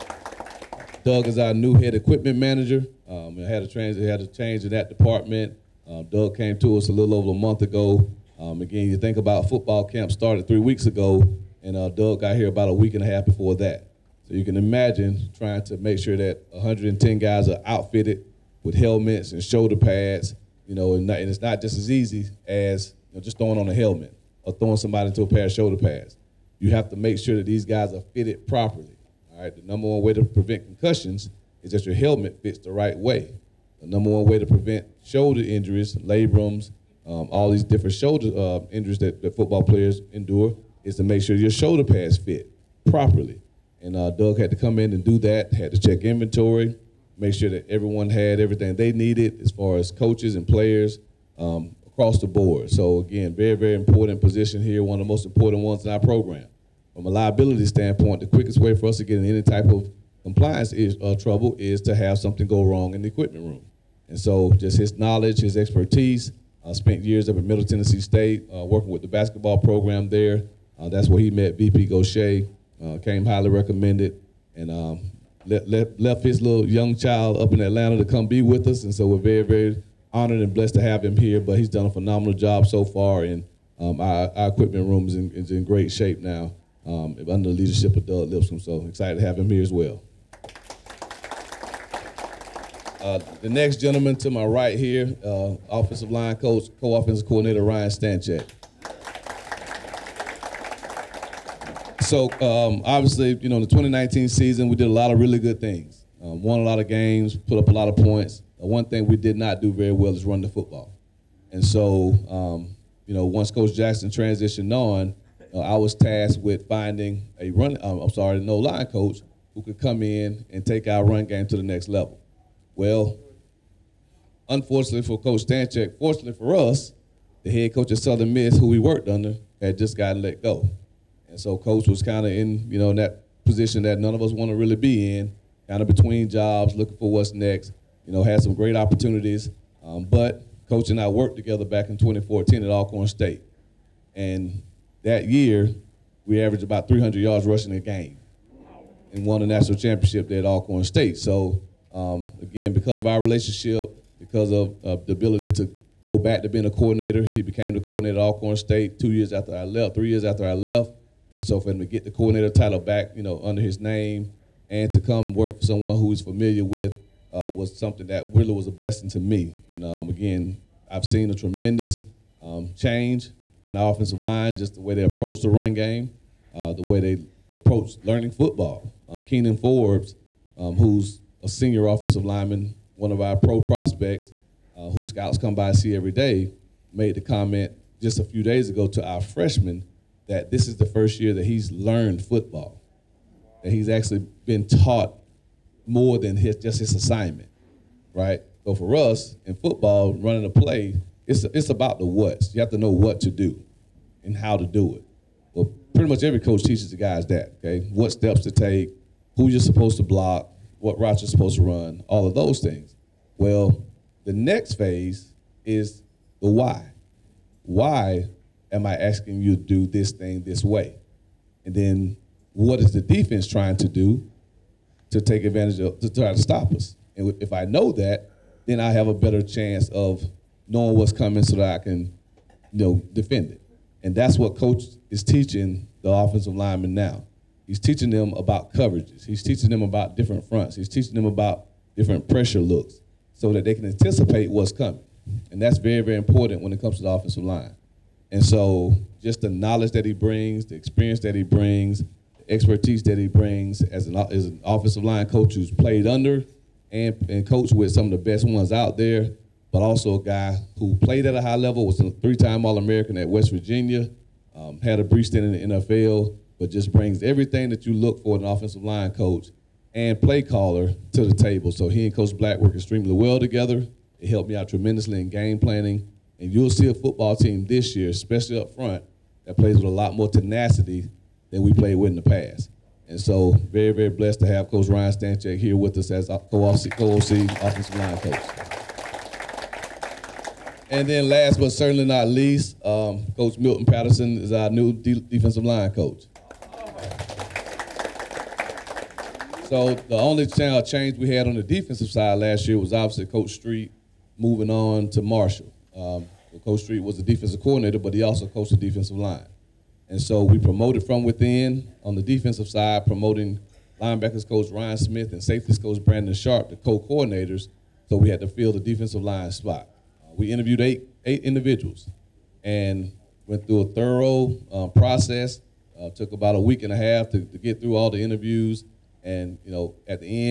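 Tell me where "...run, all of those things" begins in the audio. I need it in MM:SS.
03:31.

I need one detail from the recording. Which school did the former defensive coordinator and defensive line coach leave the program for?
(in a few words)
Marshall.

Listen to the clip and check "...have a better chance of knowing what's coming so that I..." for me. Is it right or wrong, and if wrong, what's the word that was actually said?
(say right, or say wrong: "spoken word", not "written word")
right.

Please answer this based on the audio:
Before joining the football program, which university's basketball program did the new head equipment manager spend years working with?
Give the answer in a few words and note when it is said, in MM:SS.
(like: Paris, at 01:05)
Middle Tennessee State, at 01:07.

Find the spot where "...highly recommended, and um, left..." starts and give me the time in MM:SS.
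01:13.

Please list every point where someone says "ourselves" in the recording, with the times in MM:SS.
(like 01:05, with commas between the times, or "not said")
not said.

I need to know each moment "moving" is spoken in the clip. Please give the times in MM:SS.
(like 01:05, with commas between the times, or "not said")
05:04.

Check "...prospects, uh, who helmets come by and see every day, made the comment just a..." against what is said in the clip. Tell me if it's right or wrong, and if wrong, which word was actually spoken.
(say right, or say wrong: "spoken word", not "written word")
wrong: "scouts", not "helmets".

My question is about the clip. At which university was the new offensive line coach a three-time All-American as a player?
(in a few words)
West Virginia.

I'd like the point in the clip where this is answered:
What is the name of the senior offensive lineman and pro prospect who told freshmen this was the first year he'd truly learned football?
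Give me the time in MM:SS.
02:59.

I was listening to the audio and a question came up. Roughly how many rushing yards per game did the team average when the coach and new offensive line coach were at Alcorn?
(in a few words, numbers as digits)
300.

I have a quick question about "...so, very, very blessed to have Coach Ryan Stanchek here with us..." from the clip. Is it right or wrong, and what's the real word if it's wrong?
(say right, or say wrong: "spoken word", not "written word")
right.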